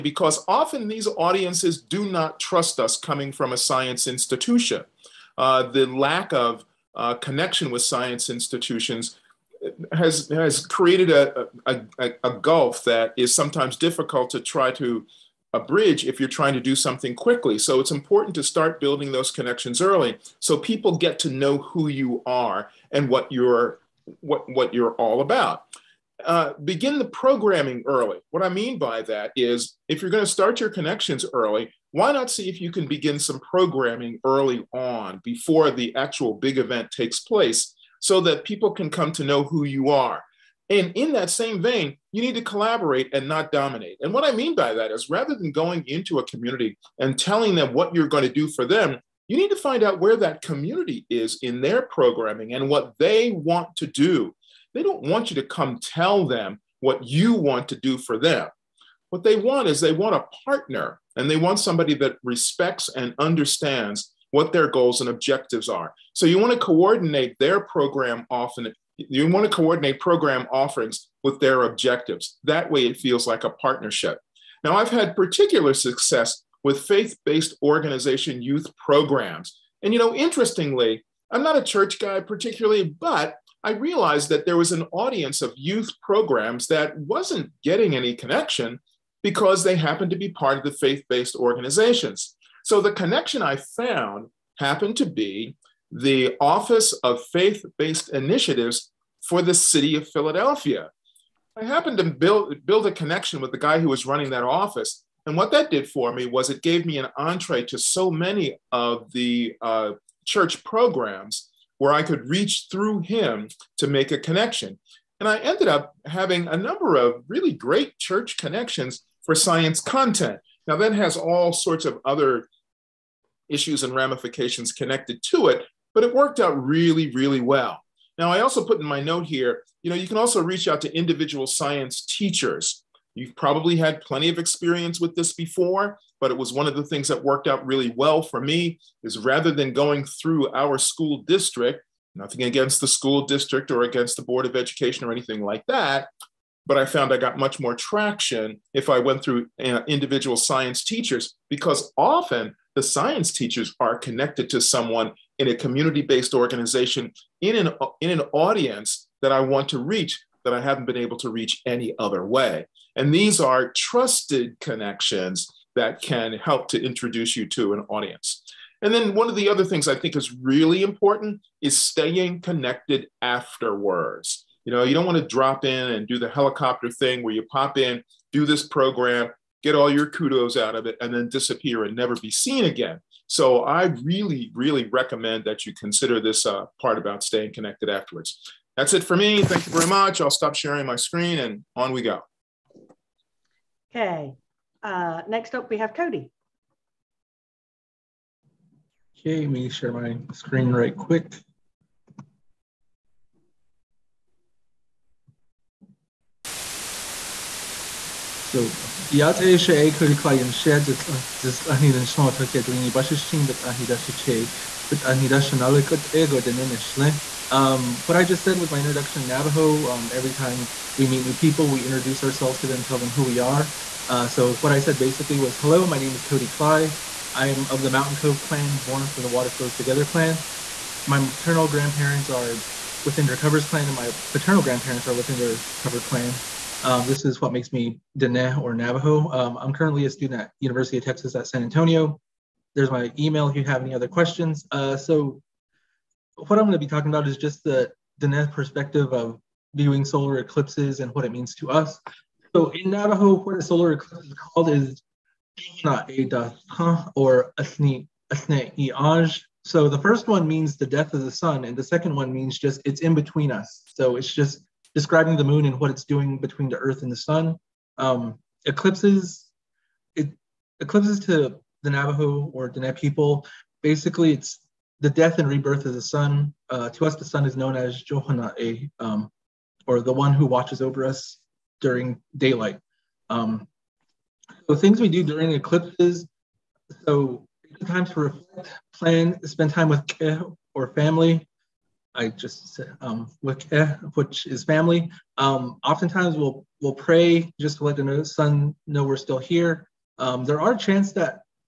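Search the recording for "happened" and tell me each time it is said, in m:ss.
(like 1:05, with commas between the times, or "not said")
1:29, 1:34, 1:41.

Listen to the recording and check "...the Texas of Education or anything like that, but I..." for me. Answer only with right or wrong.
wrong.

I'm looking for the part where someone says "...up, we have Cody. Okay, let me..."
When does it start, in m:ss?
3:15.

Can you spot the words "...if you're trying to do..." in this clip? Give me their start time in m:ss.
0:16.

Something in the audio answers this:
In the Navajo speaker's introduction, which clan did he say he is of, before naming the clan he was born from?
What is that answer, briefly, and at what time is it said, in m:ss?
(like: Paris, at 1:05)
Mountain Cove clan, at 3:47.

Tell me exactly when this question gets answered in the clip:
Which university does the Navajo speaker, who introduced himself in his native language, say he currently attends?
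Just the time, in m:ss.
4:00.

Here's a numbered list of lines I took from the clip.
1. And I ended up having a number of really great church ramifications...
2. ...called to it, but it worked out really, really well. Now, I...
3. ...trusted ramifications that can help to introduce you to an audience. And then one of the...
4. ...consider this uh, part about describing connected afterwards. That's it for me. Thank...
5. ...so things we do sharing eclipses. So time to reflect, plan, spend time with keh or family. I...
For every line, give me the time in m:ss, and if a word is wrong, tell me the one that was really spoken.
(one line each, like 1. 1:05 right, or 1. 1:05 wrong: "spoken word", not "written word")
1. 1:55 wrong: "connections", not "ramifications"
2. 2:04 wrong: "connected", not "called"
3. 2:43 wrong: "connections", not "ramifications"
4. 3:05 wrong: "staying", not "describing"
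5. 4:44 wrong: "during", not "sharing".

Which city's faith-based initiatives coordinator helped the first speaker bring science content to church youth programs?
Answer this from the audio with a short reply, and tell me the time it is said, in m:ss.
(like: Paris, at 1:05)
Philadelphia, at 1:39.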